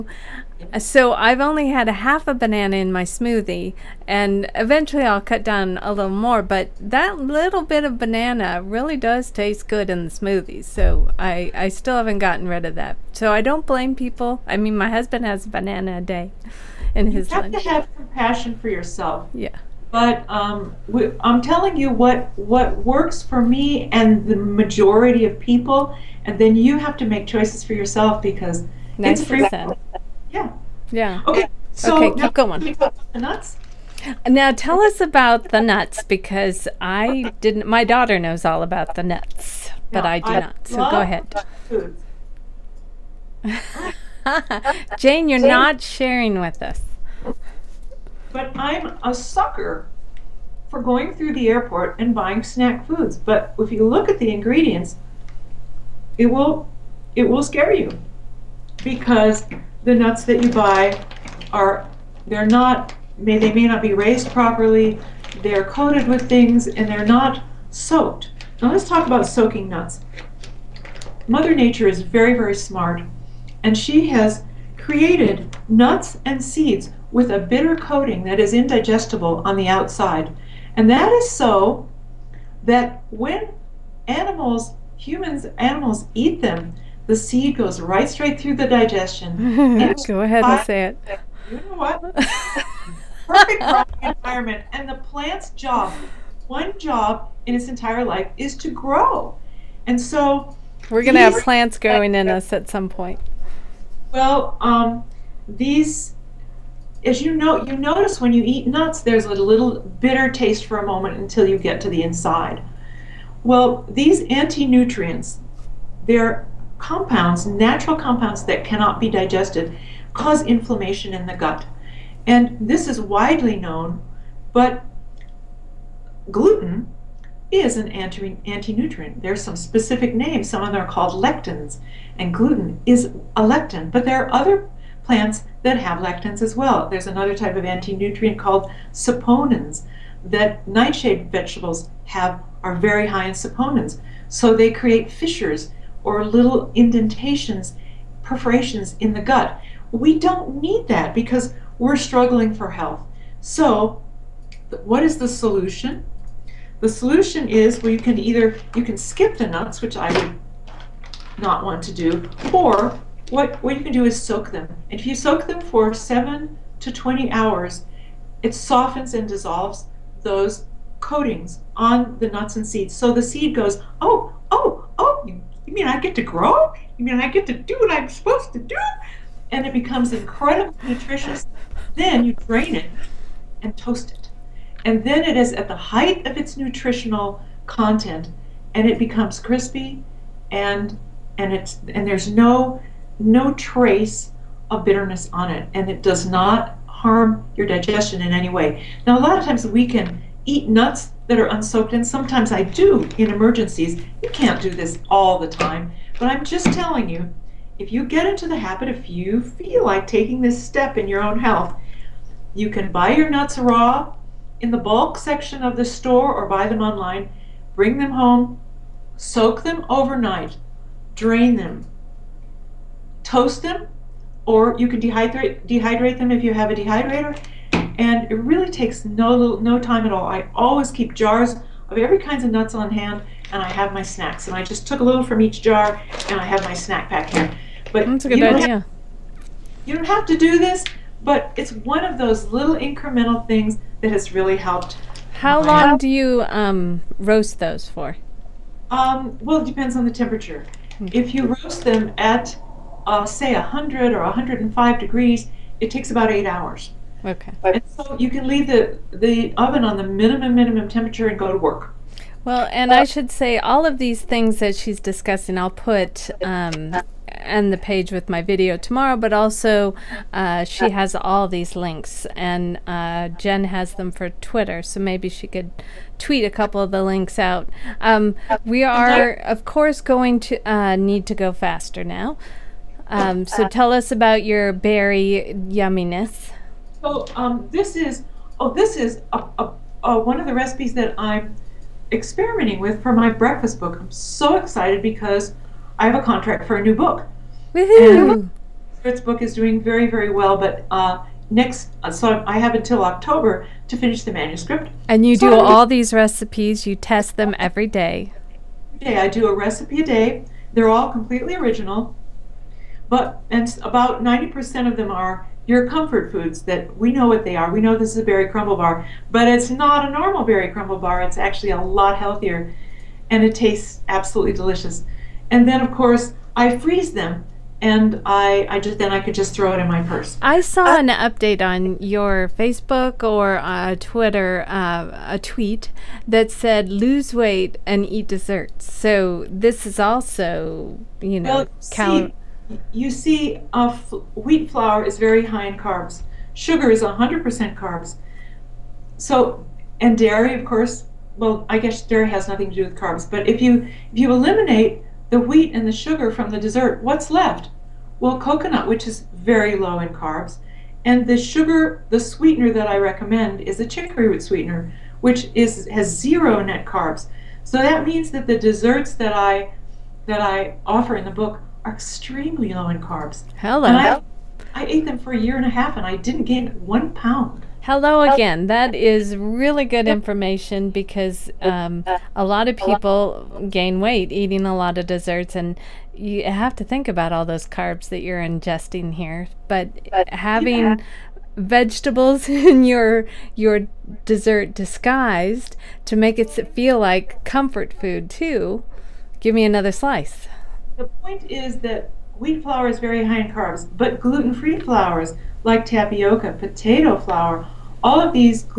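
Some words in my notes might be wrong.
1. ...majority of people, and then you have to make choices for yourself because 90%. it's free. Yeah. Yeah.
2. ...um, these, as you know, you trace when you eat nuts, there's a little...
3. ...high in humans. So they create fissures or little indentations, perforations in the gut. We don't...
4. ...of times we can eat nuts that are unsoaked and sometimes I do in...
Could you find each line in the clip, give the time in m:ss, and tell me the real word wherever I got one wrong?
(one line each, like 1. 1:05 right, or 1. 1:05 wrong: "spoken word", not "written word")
1. 0:24 right
2. 1:44 wrong: "notice", not "trace"
3. 2:23 wrong: "saponins", not "humans"
4. 3:19 right.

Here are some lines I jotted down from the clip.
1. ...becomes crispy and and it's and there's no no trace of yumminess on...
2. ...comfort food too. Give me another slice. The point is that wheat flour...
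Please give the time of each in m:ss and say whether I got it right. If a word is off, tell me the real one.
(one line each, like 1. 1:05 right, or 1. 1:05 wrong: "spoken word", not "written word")
1. 3:08 wrong: "bitterness", not "yumminess"
2. 6:37 right.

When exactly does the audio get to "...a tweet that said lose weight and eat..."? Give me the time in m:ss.
5:35.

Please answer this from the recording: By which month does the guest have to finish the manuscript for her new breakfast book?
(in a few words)
October.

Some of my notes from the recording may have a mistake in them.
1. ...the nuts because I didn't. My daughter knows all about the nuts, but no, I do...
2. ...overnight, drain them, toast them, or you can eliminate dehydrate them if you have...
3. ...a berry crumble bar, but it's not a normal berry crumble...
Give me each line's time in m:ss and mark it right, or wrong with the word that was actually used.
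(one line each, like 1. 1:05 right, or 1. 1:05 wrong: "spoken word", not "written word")
1. 0:35 right
2. 3:39 wrong: "dehydrate", not "eliminate"
3. 5:18 right.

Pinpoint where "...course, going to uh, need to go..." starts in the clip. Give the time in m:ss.
4:39.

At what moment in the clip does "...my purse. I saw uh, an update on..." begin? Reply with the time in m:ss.
5:29.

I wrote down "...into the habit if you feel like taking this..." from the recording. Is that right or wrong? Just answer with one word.
right.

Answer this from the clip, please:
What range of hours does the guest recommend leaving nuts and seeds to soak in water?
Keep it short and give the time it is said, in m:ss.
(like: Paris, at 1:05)
7 to 20 hours, at 2:45.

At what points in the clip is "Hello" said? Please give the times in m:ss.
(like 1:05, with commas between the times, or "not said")
6:13, 6:17.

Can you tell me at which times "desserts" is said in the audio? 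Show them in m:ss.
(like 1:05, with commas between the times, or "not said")
5:38, 5:56, 6:08, 6:25, 6:34.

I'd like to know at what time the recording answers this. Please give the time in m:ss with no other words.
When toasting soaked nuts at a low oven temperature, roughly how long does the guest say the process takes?
4:16.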